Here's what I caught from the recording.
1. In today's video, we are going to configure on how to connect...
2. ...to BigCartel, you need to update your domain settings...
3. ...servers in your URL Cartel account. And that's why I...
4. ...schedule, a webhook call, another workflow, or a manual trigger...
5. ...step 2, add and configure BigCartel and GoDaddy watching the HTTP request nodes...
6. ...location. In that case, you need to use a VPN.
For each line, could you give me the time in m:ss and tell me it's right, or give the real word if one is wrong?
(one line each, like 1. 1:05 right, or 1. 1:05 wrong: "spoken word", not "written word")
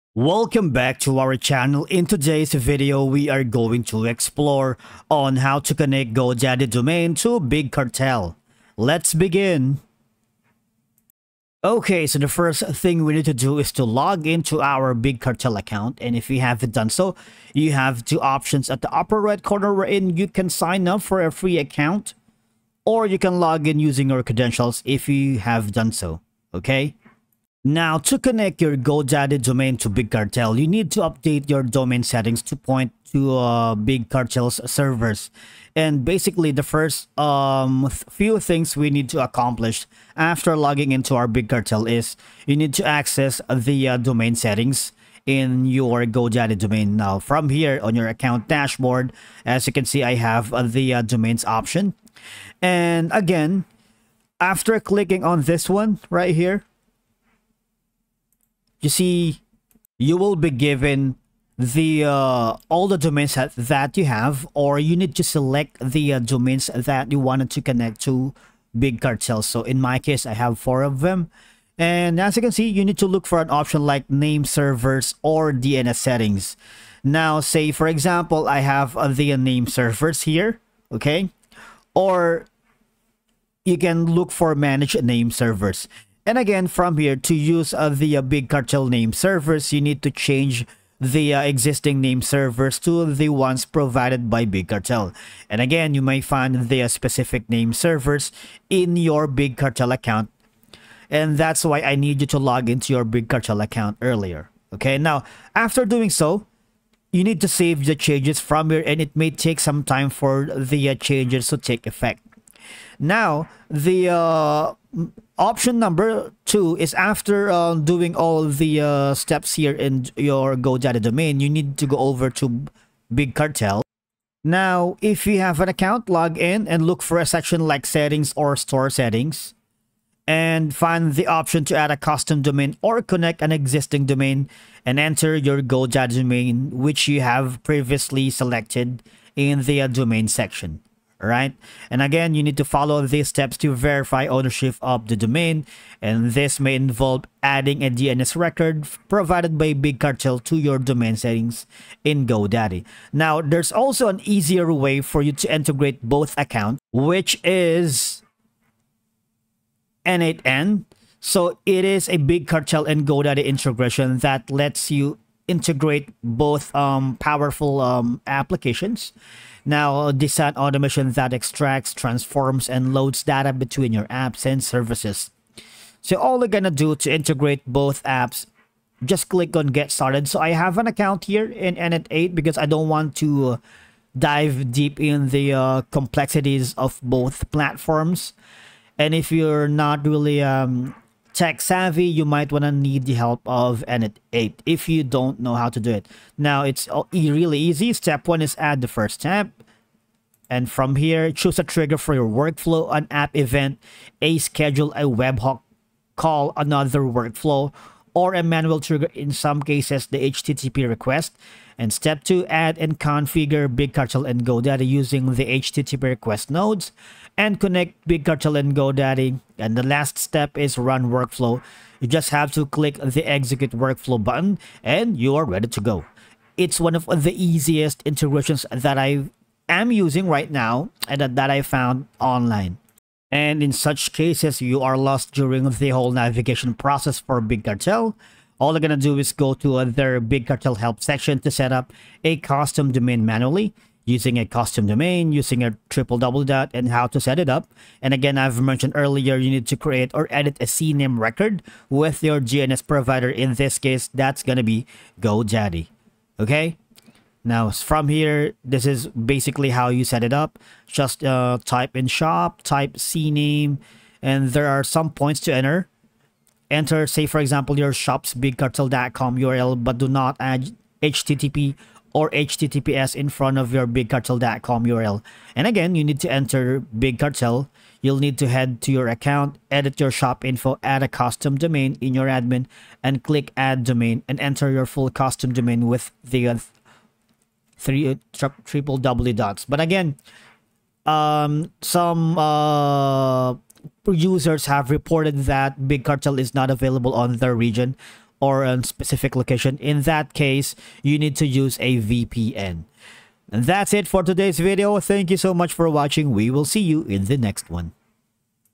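1. 0:01 wrong: "explore", not "configure"
2. 0:29 right
3. 1:37 wrong: "Big", not "URL"
4. 3:24 right
5. 3:31 wrong: "using", not "watching"
6. 4:59 right.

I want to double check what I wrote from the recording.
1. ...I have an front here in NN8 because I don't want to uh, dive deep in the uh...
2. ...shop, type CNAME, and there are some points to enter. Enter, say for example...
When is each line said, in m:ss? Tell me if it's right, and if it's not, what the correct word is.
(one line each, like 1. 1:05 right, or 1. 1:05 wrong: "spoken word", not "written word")
1. 3:00 wrong: "account", not "front"
2. 4:22 right.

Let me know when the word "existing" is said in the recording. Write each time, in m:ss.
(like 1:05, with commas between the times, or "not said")
1:31, 2:13.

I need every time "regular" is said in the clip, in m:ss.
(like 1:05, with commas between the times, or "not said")
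not said.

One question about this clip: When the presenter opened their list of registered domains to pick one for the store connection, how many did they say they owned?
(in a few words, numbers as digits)
4.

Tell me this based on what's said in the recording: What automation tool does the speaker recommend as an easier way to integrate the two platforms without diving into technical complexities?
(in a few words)
N8N.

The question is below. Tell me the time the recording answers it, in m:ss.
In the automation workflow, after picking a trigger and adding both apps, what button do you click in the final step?
3:43.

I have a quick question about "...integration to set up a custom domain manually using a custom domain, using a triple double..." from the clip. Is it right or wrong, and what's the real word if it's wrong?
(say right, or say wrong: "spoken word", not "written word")
wrong: "section", not "integration".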